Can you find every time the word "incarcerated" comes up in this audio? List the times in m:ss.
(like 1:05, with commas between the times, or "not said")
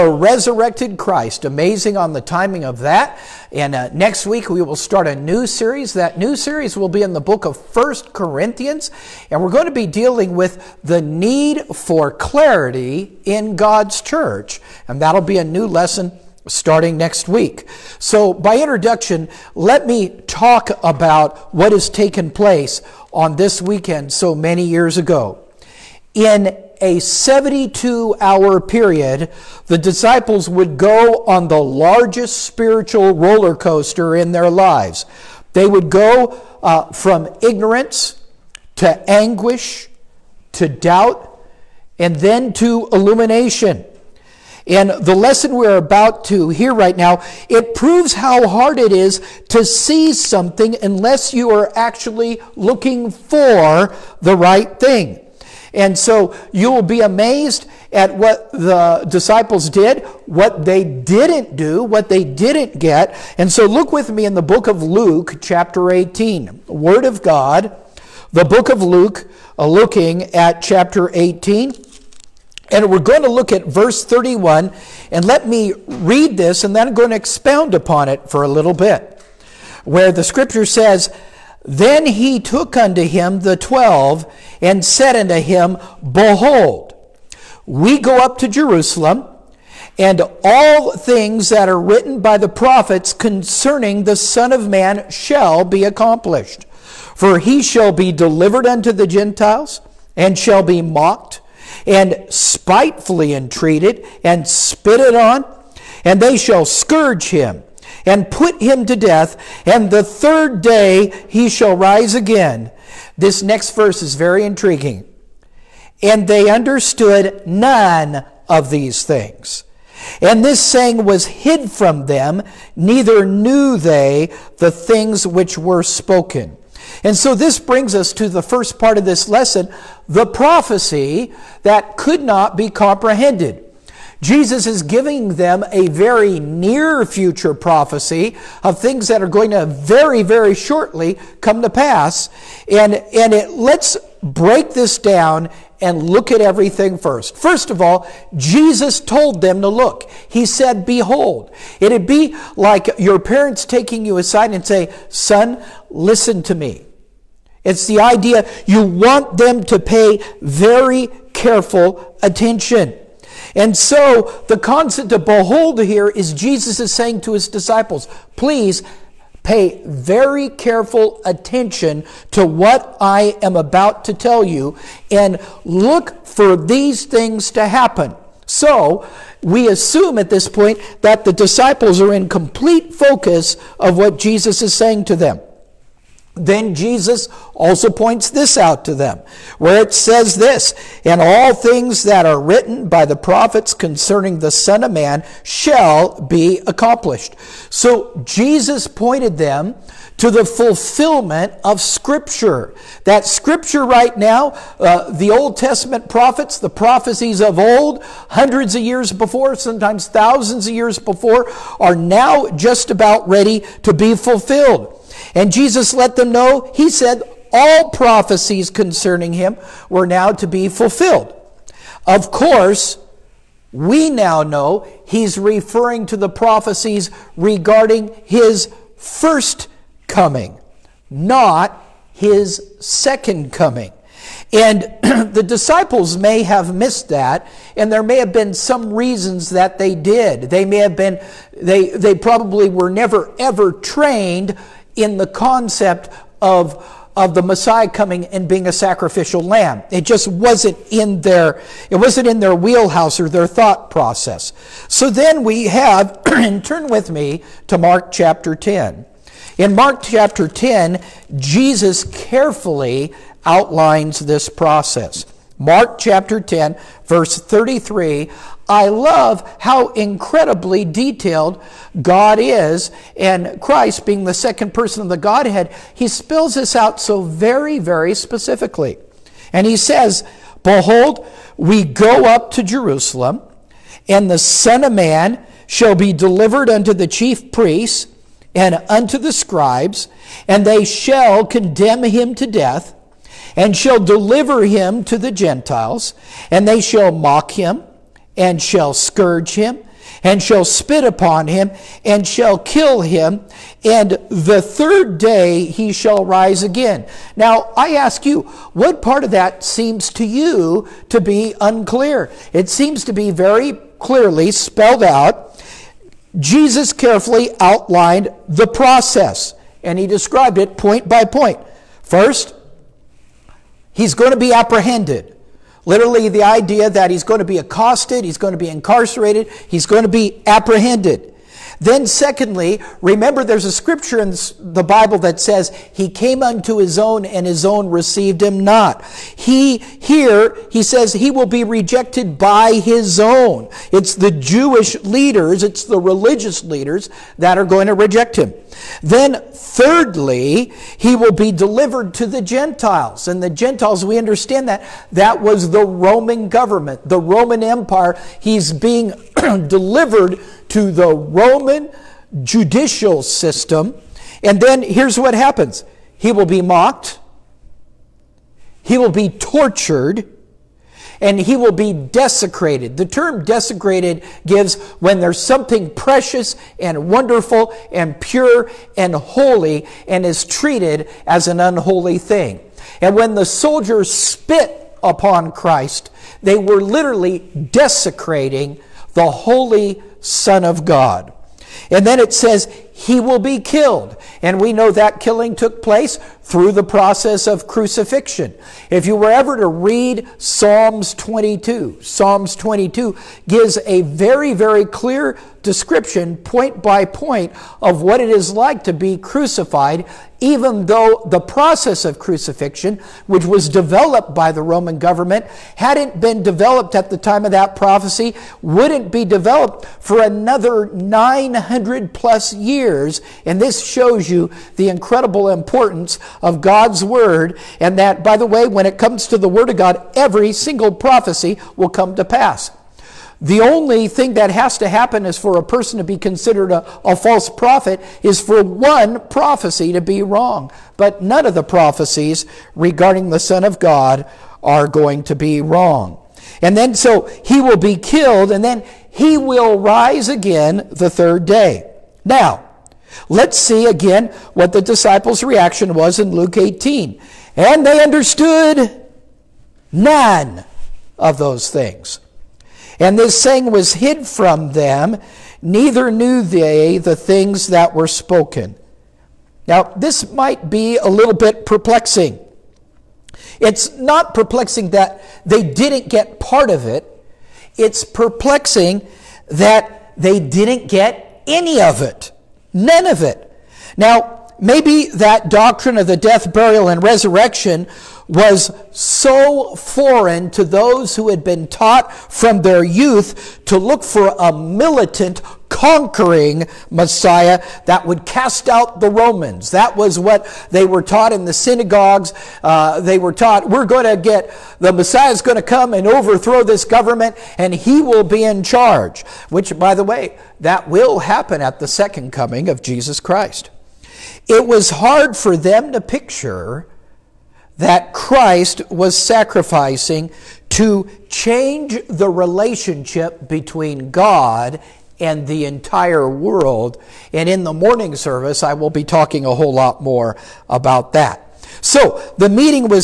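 5:28.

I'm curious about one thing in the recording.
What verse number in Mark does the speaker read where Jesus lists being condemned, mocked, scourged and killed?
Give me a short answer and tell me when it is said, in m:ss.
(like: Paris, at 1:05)
33, at 4:27.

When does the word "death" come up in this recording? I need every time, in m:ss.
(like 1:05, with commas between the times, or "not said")
1:48, 4:52, 8:06.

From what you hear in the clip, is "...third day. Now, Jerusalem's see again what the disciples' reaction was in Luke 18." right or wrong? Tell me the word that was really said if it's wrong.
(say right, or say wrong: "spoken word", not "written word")
wrong: "Let", not "Jerusalem".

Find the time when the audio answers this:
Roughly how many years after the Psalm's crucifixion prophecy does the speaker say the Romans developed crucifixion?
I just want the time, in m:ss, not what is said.
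7:00.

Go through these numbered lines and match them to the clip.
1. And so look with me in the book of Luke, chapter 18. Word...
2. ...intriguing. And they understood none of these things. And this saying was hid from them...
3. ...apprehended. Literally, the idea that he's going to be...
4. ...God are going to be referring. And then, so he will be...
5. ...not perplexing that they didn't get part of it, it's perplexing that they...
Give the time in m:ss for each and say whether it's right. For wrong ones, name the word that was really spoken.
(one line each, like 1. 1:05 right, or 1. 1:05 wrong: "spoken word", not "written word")
1. 1:03 right
2. 1:54 right
3. 5:24 right
4. 7:23 wrong: "wrong", not "referring"
5. 7:53 right.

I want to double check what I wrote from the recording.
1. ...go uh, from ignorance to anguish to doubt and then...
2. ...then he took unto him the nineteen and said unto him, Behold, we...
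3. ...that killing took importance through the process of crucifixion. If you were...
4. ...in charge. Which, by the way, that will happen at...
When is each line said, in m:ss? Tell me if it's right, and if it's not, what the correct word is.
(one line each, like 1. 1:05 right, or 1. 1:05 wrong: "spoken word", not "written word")
1. 0:35 right
2. 1:21 wrong: "twelve", not "nineteen"
3. 6:34 wrong: "place", not "importance"
4. 8:28 right.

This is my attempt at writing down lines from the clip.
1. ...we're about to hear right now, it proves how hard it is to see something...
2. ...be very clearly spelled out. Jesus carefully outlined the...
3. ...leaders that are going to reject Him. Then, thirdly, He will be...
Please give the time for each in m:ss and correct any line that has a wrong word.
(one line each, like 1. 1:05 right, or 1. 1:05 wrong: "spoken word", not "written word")
1. 0:45 right
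2. 5:13 right
3. 5:46 right.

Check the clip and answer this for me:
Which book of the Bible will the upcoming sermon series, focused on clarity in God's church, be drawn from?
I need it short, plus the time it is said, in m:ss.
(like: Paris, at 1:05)
First Corinthians, at 0:07.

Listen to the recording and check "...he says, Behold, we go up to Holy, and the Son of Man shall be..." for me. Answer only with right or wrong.
wrong.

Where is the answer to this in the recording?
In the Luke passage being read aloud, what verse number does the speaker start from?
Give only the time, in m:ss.
1:13.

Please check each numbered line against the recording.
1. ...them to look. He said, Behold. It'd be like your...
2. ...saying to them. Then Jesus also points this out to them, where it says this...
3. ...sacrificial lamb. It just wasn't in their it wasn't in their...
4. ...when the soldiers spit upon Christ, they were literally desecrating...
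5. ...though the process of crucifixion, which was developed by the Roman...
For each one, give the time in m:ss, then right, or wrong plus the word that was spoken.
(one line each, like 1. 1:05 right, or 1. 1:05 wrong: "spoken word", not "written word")
1. 2:29 right
2. 3:04 right
3. 4:08 right
4. 6:23 right
5. 6:50 right.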